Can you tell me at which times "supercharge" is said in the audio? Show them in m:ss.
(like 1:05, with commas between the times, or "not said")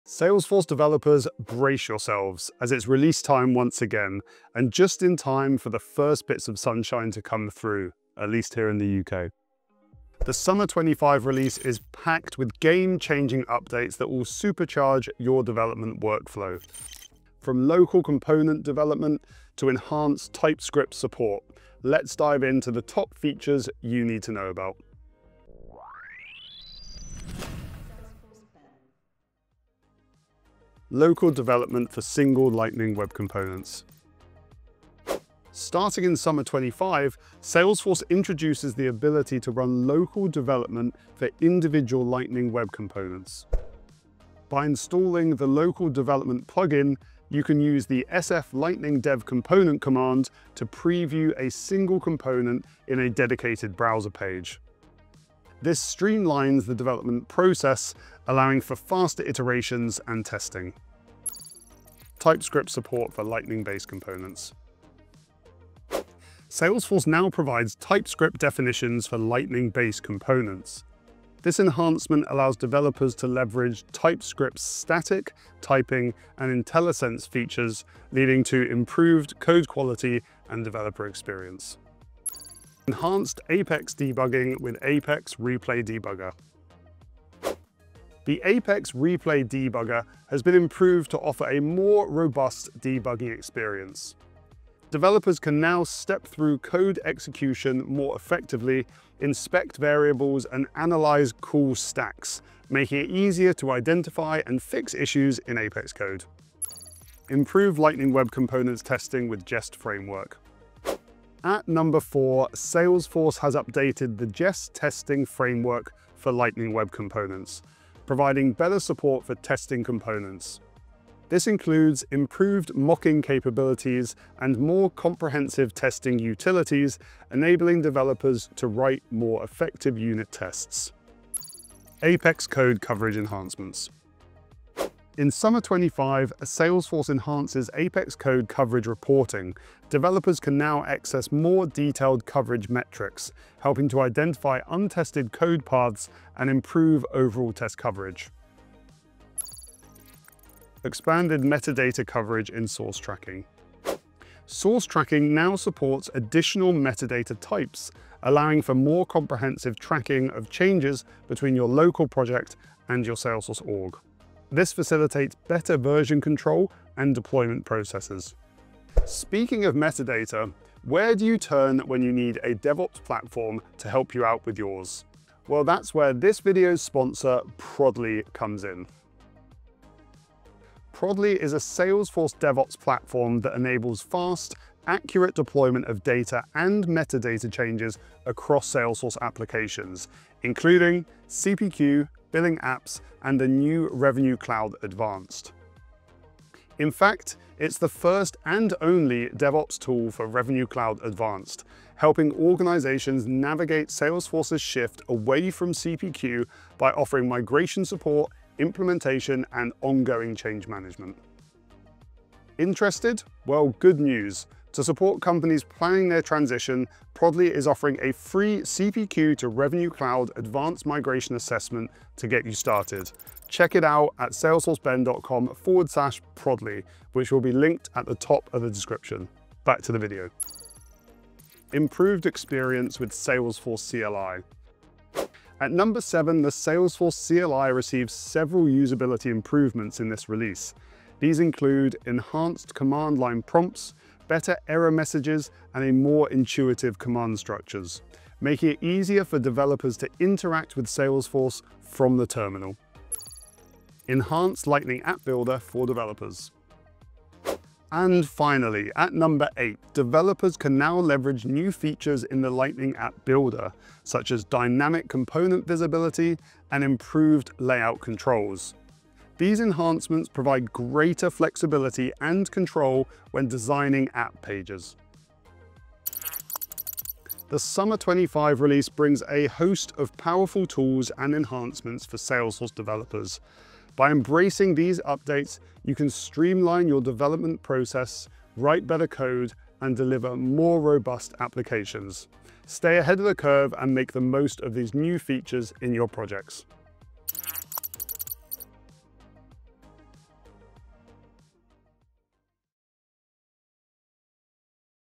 0:14.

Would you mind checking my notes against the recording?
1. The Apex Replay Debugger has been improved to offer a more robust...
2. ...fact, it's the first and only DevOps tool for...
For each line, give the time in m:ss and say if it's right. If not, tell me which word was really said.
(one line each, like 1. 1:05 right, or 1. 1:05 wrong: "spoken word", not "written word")
1. 1:28 right
2. 3:16 right.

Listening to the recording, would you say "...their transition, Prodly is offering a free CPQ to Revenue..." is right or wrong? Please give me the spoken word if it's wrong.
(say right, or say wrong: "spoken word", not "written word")
right.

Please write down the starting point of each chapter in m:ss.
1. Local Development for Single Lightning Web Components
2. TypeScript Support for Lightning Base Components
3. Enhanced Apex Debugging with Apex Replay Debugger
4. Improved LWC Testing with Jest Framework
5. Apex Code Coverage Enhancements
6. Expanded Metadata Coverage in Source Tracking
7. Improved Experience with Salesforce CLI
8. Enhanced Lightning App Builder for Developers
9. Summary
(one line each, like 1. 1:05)
1. 0:29
2. 1:02
3. 1:23
4. 1:46
5. 2:12
6. 2:30
7. 3:52
8. 4:14
9. 4:37.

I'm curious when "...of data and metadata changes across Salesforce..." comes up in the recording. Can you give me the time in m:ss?
3:05.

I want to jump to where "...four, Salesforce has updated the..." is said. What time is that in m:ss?
1:51.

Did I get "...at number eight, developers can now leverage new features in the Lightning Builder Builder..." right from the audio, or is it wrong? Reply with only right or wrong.
wrong.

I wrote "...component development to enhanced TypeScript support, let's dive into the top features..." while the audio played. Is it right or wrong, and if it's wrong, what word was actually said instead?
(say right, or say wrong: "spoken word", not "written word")
right.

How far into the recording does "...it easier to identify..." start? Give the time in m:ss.
1:42.